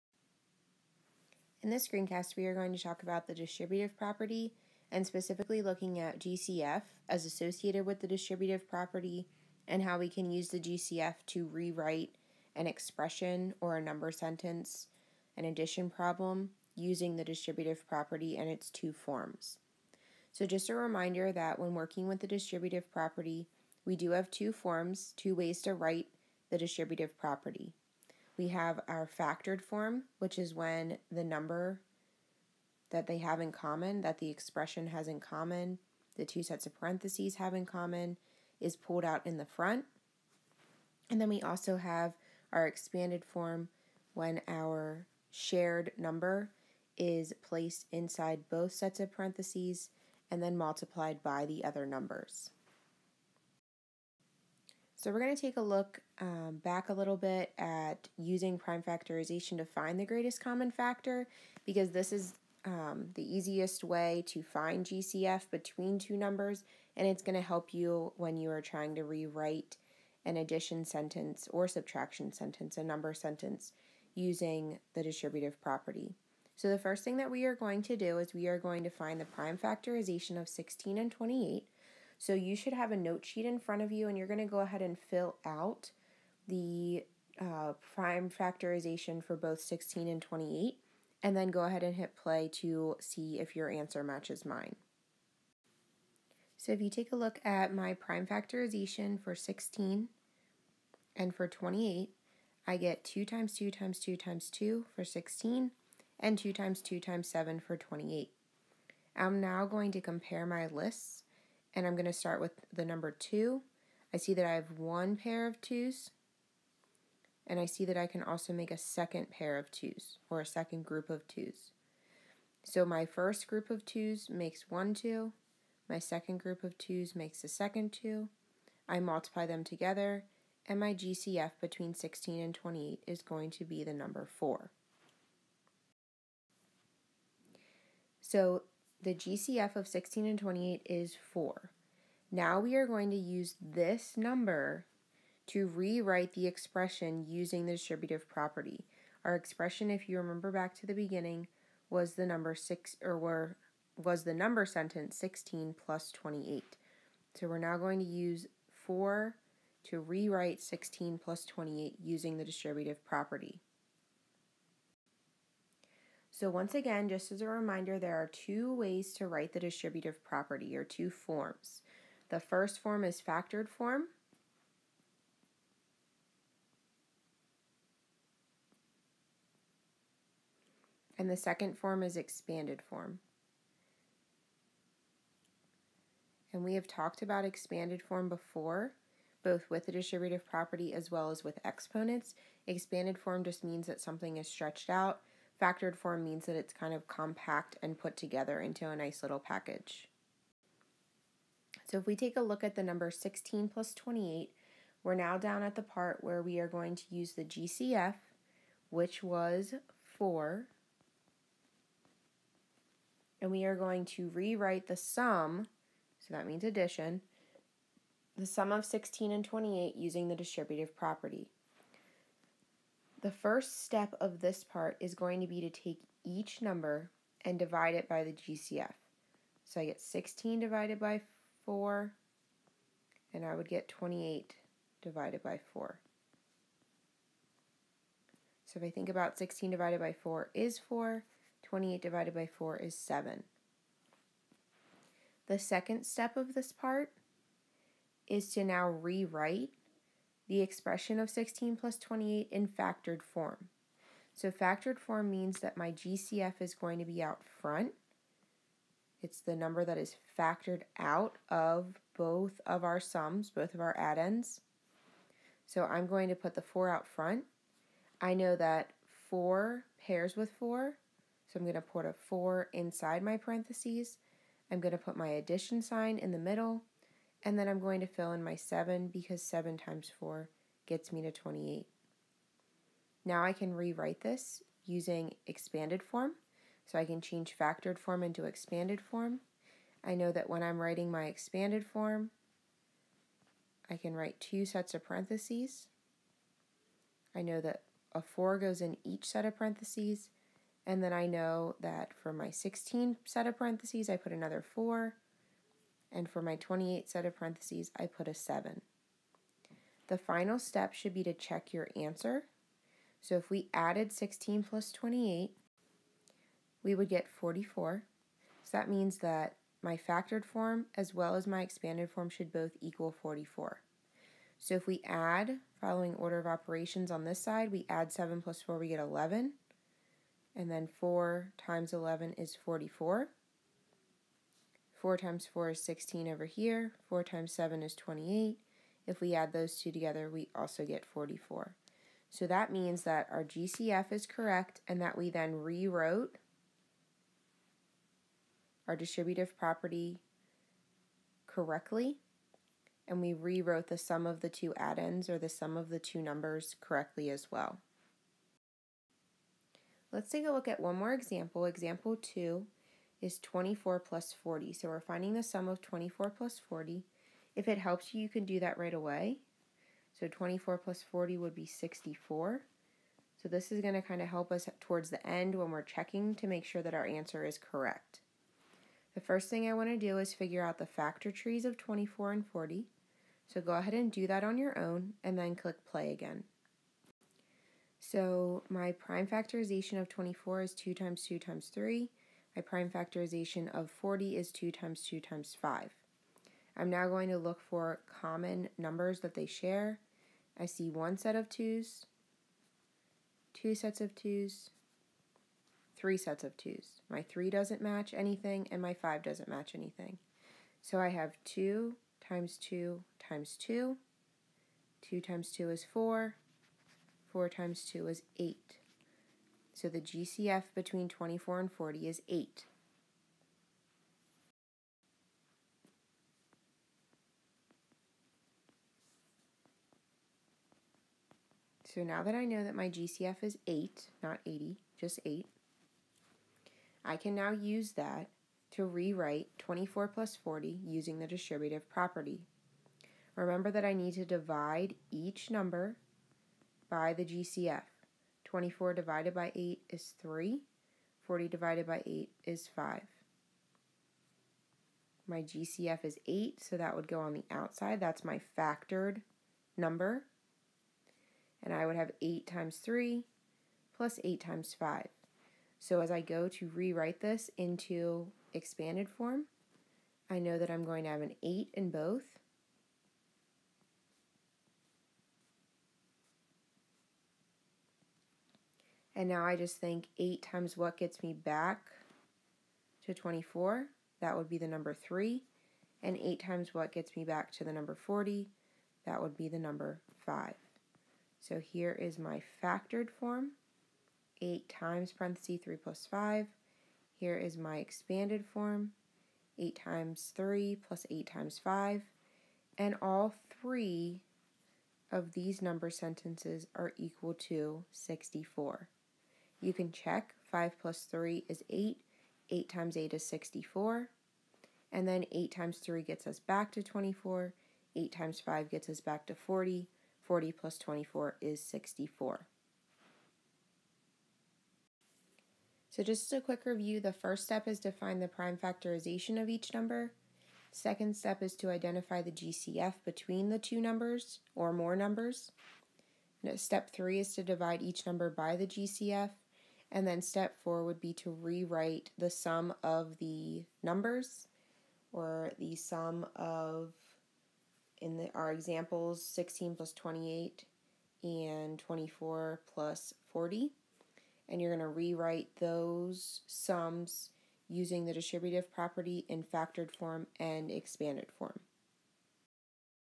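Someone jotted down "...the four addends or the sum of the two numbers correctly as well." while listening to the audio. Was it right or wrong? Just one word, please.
wrong.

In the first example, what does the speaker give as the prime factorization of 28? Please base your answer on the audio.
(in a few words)
2 times 2 times 7.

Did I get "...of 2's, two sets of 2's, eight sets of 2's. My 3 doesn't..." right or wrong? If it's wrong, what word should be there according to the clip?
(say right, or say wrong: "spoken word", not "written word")
wrong: "three", not "eight".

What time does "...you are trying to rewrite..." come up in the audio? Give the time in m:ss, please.
1:08.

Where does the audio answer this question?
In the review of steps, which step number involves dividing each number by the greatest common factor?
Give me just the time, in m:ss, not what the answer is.
8:56.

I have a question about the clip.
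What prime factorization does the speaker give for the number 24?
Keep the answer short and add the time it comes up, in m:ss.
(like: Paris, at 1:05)
2 times 2 times 3, at 6:30.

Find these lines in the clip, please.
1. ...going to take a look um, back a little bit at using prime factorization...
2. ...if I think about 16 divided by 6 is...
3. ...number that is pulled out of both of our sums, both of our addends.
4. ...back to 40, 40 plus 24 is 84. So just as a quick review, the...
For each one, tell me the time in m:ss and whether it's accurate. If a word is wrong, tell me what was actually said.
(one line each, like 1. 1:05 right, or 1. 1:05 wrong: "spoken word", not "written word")
1. 0:55 right
2. 3:58 wrong: "4", not "6"
3. 4:19 wrong: "factored", not "pulled"
4. 8:38 wrong: "64", not "84".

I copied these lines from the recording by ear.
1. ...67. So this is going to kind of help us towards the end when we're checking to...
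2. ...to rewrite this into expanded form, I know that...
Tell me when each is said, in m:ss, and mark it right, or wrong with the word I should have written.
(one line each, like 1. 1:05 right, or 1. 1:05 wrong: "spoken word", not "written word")
1. 6:11 wrong: "64", not "67"
2. 7:46 right.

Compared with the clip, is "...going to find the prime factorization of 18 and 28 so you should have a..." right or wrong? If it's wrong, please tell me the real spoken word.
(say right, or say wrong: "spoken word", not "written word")
wrong: "16", not "18".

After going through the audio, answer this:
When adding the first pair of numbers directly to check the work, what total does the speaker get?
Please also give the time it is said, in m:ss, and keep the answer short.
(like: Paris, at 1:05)
44, at 5:16.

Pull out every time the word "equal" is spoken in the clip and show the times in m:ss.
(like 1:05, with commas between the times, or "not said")
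5:22, 8:26.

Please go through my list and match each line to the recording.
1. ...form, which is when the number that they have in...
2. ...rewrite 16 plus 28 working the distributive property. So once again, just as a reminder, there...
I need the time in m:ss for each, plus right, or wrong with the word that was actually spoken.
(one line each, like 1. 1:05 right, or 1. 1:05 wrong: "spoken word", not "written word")
1. 0:29 right
2. 2:39 wrong: "using", not "working".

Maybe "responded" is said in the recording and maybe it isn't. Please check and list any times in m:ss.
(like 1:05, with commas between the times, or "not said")
not said.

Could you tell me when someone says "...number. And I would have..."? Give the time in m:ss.
7:39.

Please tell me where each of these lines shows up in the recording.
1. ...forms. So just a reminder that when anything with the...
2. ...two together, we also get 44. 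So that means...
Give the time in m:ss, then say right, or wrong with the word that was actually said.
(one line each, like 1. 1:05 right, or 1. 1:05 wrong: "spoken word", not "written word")
1. 0:18 wrong: "working", not "anything"
2. 5:39 right.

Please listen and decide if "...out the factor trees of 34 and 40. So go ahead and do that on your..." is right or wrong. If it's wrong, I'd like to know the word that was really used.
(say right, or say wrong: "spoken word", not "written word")
wrong: "24", not "34".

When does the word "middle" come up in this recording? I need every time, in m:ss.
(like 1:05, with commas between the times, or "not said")
4:36.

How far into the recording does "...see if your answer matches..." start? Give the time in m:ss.
1:32.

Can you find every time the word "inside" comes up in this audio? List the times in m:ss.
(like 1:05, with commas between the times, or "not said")
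0:47, 4:32.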